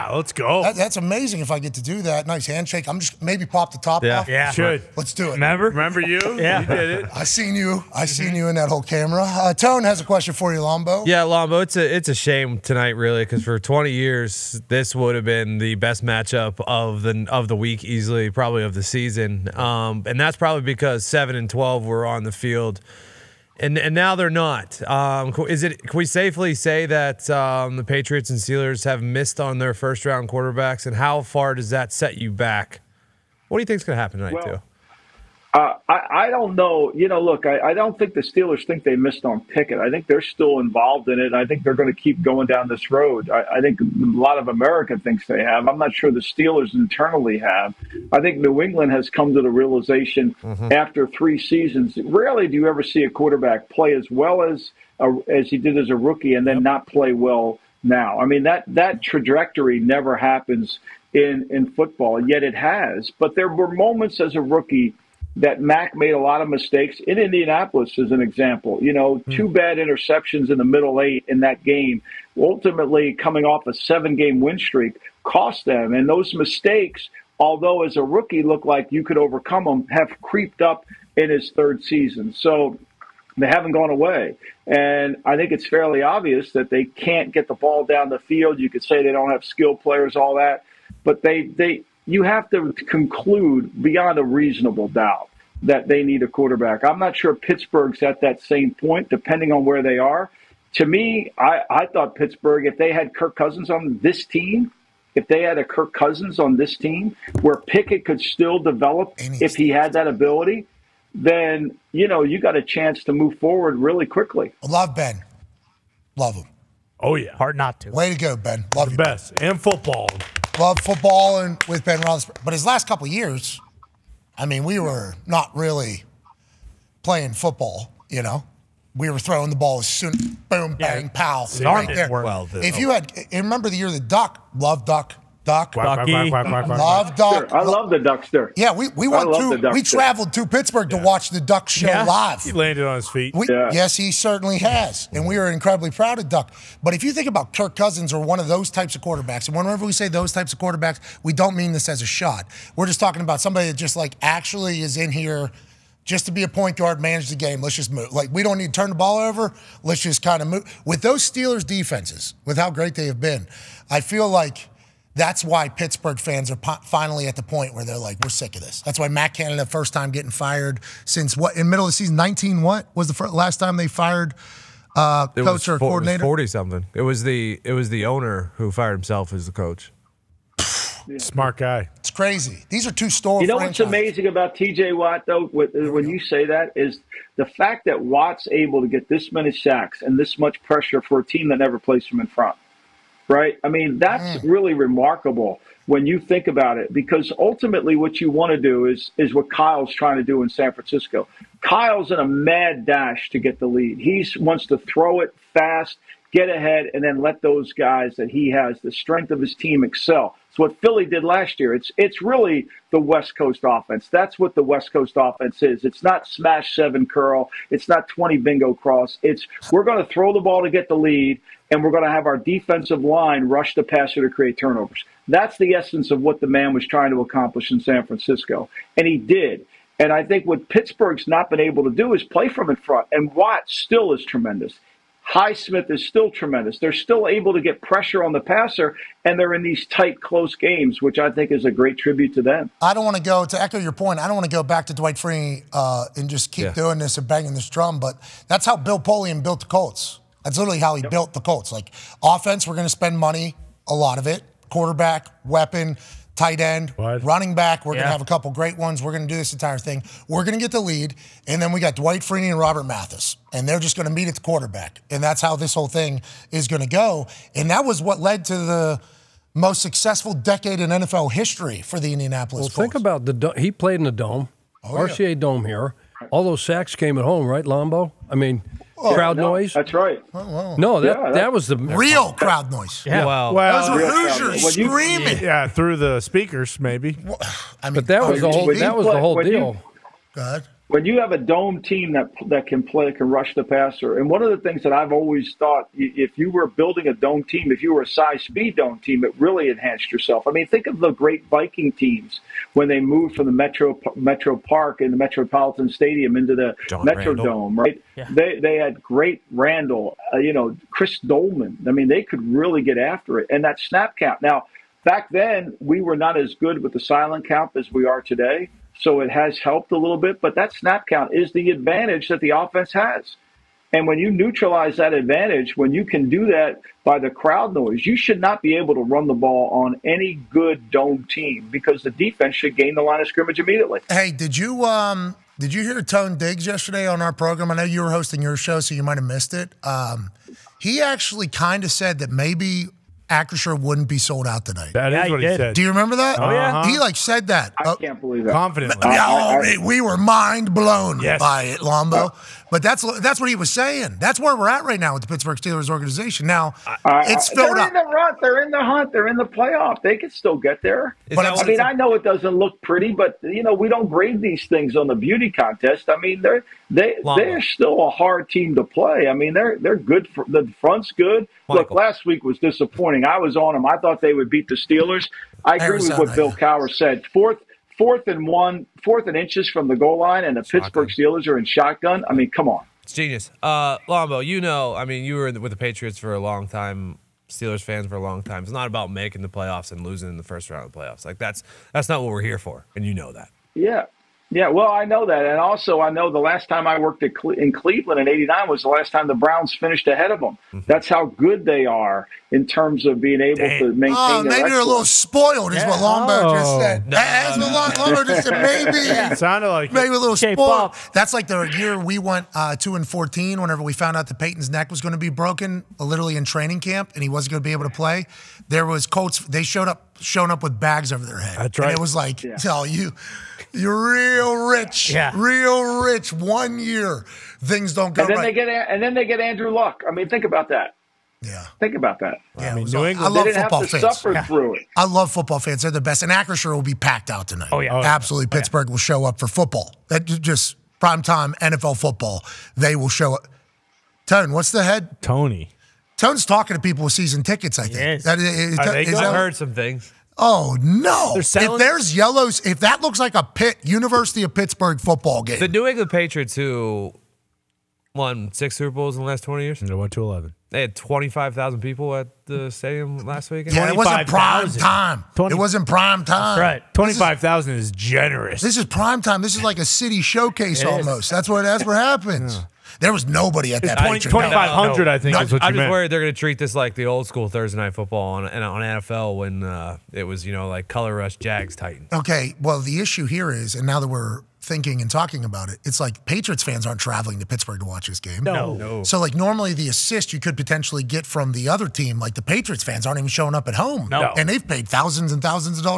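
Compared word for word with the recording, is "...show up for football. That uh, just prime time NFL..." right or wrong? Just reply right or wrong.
right.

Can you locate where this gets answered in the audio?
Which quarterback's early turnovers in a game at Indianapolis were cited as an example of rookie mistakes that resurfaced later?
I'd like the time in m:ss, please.
1:05.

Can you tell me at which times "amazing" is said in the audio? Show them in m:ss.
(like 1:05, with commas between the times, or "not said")
0:00, 3:03.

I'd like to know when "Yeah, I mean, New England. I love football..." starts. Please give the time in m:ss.
7:12.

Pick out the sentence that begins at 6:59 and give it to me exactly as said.
They showed up, showing up with bags over their head.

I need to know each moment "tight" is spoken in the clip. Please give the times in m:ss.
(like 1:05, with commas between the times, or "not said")
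3:59, 4:16.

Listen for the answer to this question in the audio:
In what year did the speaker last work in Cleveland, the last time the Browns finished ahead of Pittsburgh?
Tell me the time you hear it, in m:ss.
6:38.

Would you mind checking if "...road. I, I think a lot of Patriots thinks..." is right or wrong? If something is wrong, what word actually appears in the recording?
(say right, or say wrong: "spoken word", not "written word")
wrong: "America", not "Patriots".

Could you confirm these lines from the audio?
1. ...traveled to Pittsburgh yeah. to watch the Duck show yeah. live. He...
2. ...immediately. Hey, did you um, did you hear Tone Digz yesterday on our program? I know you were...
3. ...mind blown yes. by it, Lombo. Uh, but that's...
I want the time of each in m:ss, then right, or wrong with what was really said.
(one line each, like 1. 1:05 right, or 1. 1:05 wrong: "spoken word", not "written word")
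1. 2:19 right
2. 5:33 right
3. 5:50 right.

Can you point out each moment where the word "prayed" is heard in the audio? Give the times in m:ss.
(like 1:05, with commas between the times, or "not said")
not said.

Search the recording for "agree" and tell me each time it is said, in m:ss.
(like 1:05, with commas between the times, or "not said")
6:15.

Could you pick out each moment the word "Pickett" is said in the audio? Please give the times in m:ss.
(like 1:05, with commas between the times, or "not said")
0:39, 1:47.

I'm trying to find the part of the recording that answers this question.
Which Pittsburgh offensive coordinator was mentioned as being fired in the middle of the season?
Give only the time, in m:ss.
2:49.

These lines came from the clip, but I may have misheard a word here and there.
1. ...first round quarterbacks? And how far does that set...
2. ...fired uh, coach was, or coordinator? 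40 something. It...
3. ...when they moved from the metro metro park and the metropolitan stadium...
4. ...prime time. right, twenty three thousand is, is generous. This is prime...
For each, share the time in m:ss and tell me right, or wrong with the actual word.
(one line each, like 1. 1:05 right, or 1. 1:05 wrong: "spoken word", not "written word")
1. 0:29 right
2. 2:53 right
3. 5:02 right
4. 7:45 wrong: "five", not "three".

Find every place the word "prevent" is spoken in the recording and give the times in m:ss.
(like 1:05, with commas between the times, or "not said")
not said.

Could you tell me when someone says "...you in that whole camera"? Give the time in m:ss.
0:08.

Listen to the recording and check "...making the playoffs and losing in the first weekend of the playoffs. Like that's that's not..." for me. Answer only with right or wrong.
wrong.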